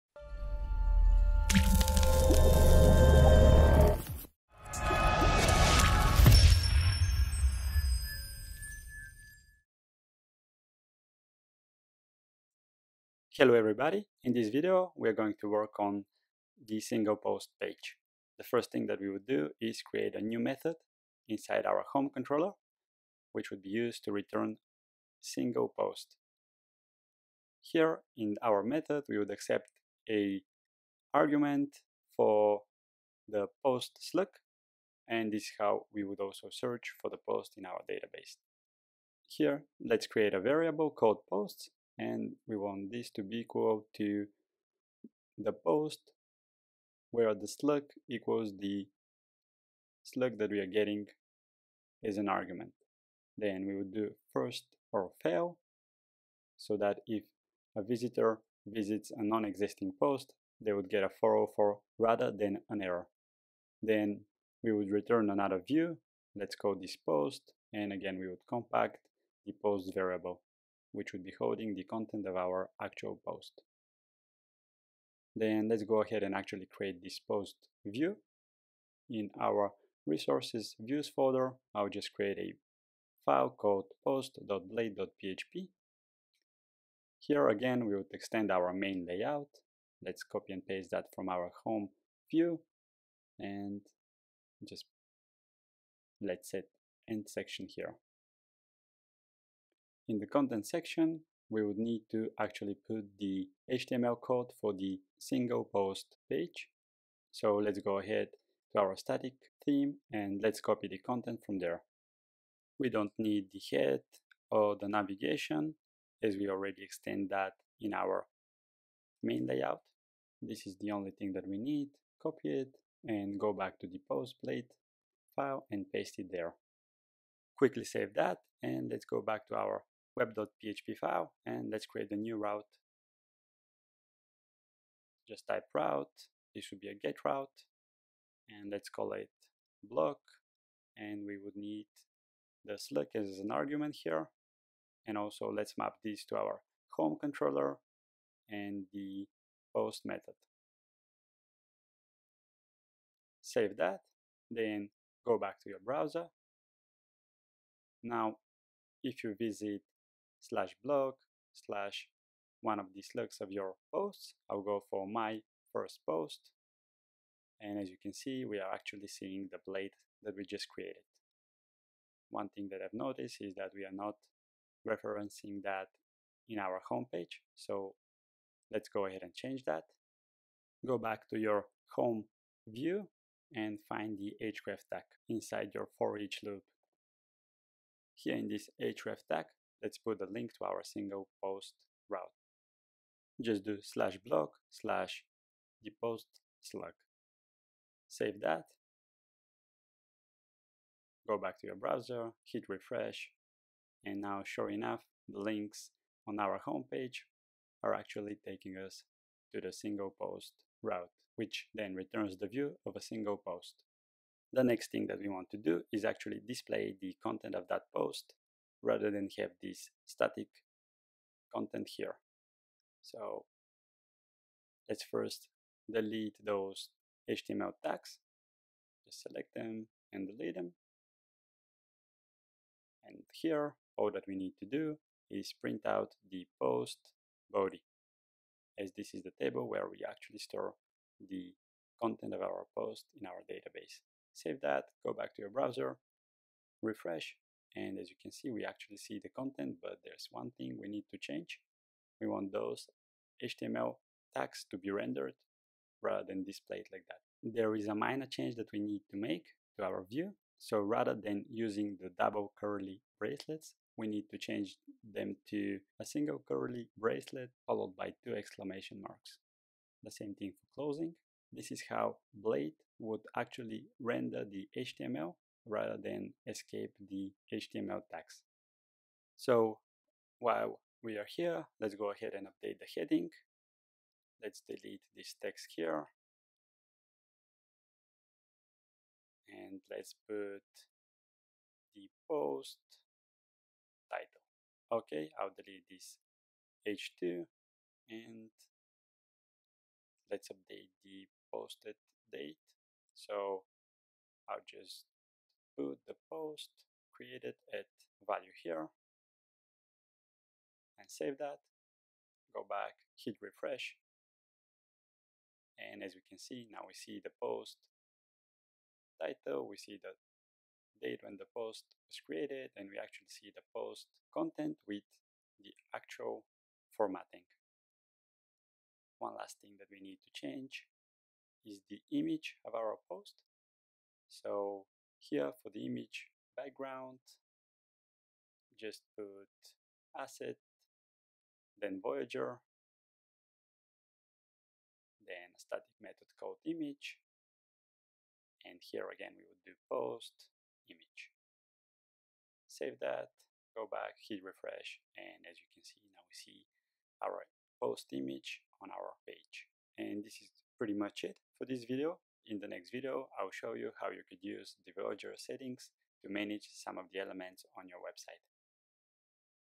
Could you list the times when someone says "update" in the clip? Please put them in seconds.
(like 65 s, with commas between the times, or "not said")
282 s, 300 s.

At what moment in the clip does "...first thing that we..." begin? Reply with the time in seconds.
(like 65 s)
18 s.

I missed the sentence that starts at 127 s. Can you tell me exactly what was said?
Quickly save that and let's go back to our web.php file and let's create a new route.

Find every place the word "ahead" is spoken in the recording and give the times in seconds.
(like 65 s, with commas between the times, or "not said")
76 s, 107 s, 179 s, 282 s.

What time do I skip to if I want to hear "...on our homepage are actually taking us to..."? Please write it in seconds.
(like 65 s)
206 s.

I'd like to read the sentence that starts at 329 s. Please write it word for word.
One last thing that we need to change is the image of our post.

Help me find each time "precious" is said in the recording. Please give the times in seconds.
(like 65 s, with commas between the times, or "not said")
not said.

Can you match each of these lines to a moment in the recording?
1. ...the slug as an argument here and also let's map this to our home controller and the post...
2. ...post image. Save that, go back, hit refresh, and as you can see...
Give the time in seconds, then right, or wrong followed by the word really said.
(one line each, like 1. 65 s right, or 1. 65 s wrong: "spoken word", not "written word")
1. 142 s right
2. 349 s right.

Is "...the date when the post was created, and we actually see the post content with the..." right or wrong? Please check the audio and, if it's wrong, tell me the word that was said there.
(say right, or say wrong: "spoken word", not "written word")
right.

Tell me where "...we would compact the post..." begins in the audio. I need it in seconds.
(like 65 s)
68 s.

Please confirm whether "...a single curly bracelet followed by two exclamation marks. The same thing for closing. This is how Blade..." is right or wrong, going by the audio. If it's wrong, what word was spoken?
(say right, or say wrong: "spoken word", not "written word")
right.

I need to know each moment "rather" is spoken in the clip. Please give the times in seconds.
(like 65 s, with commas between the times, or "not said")
61 s, 218 s, 256 s, 260 s, 275 s.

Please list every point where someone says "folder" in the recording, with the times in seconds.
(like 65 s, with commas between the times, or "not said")
81 s.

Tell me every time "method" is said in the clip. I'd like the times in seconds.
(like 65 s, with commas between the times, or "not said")
20 s, 28 s, 150 s, 346 s.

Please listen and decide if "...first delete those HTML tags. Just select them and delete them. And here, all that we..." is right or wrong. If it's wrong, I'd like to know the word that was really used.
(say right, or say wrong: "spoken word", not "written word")
right.